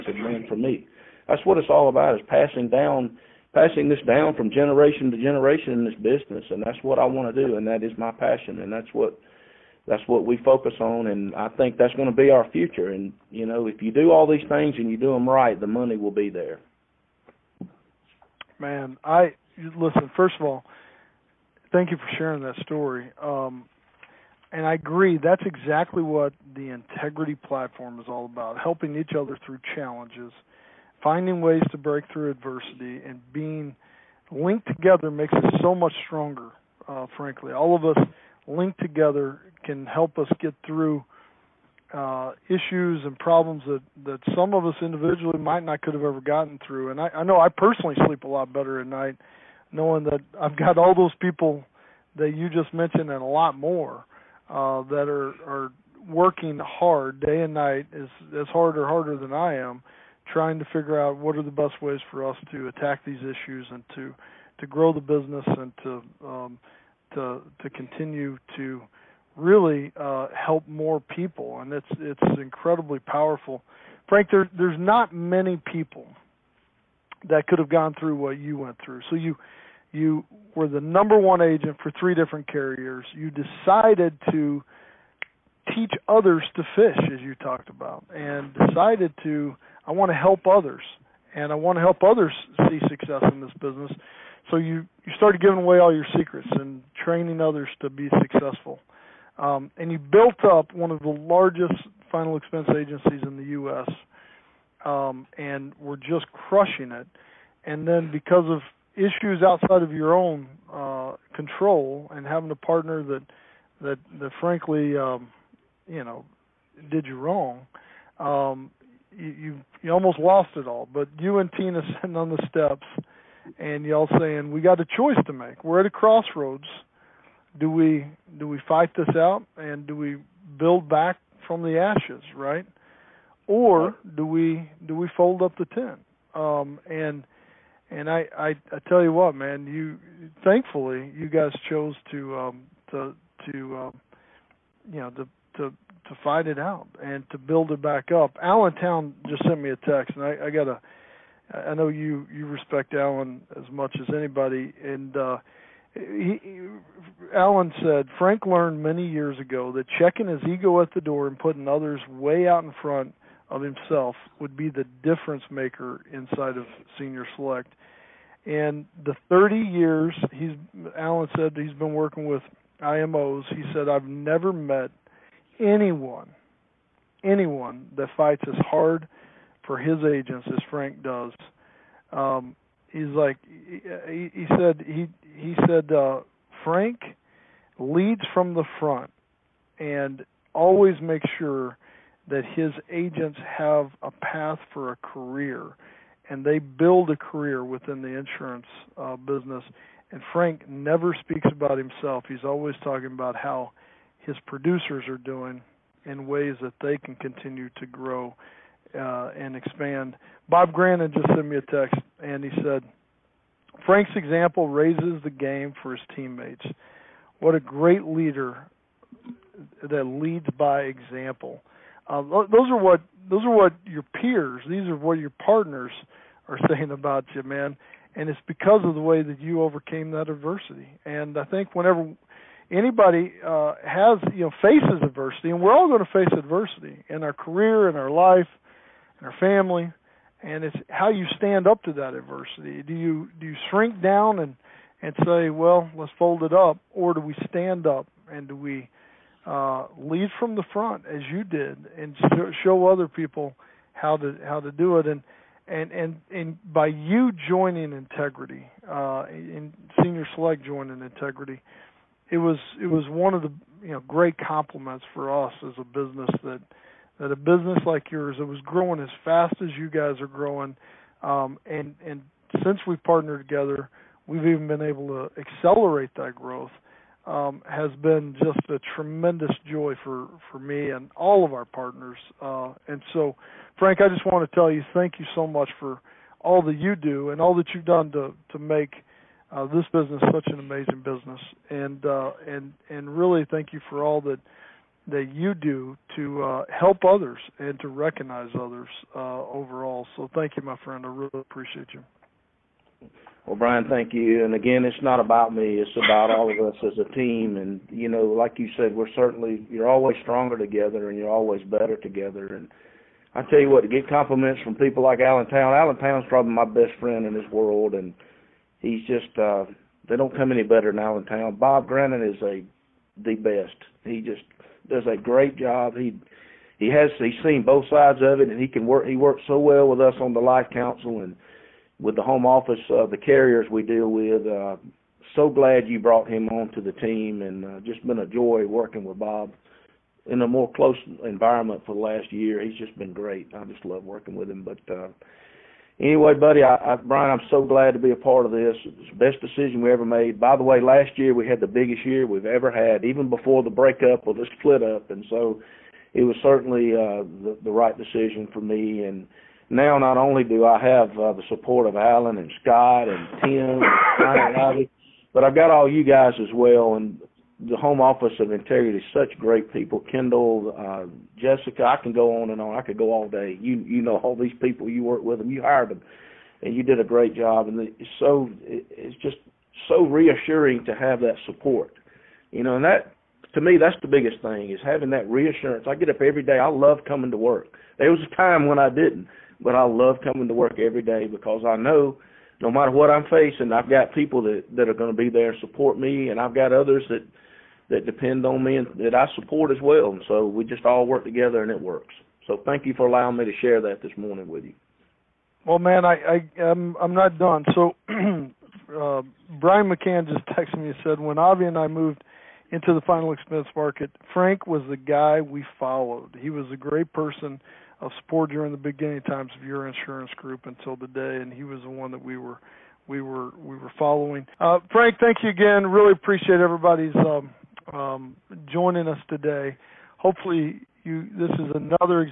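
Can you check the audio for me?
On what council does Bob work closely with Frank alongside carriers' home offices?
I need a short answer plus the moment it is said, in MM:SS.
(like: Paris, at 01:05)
Life council, at 05:30.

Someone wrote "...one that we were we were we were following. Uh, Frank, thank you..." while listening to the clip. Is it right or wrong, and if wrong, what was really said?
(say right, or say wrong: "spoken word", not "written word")
right.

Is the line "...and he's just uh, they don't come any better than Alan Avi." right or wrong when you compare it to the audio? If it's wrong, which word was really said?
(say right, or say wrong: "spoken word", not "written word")
wrong: "Town", not "Avi".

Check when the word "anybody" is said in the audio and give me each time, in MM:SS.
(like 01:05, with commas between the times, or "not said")
02:34, 03:52.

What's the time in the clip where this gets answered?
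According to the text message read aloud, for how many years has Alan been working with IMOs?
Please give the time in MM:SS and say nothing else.
02:49.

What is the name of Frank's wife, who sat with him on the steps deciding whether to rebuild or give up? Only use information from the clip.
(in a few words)
Tina.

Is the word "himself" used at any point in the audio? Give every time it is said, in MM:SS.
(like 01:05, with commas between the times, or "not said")
02:43, 03:21.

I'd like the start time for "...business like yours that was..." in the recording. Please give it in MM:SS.
04:27.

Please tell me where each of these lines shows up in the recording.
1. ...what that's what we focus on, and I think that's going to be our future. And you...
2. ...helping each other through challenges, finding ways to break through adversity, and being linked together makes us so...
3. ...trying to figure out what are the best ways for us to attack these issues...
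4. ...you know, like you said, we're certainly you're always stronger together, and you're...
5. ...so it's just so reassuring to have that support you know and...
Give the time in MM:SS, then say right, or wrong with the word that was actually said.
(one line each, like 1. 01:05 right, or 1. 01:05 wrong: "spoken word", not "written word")
1. 00:08 right
2. 00:28 right
3. 01:00 right
4. 05:07 right
5. 06:18 right.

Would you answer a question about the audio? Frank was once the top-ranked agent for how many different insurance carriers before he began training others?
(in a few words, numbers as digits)
3.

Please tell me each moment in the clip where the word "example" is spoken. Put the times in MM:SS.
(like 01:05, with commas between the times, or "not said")
03:34, 03:40.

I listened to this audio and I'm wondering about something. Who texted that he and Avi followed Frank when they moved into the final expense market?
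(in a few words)
Brian McCann.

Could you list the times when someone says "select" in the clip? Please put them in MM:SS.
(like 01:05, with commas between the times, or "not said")
02:47, 04:20.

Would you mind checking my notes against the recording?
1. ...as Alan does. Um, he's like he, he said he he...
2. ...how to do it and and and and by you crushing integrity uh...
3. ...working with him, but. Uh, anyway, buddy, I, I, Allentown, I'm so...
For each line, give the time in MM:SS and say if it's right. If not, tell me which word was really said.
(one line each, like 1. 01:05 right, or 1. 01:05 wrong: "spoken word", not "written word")
1. 03:00 wrong: "Frank", not "Alan"
2. 04:14 wrong: "joining", not "crushing"
3. 05:44 wrong: "Bryan", not "Allentown".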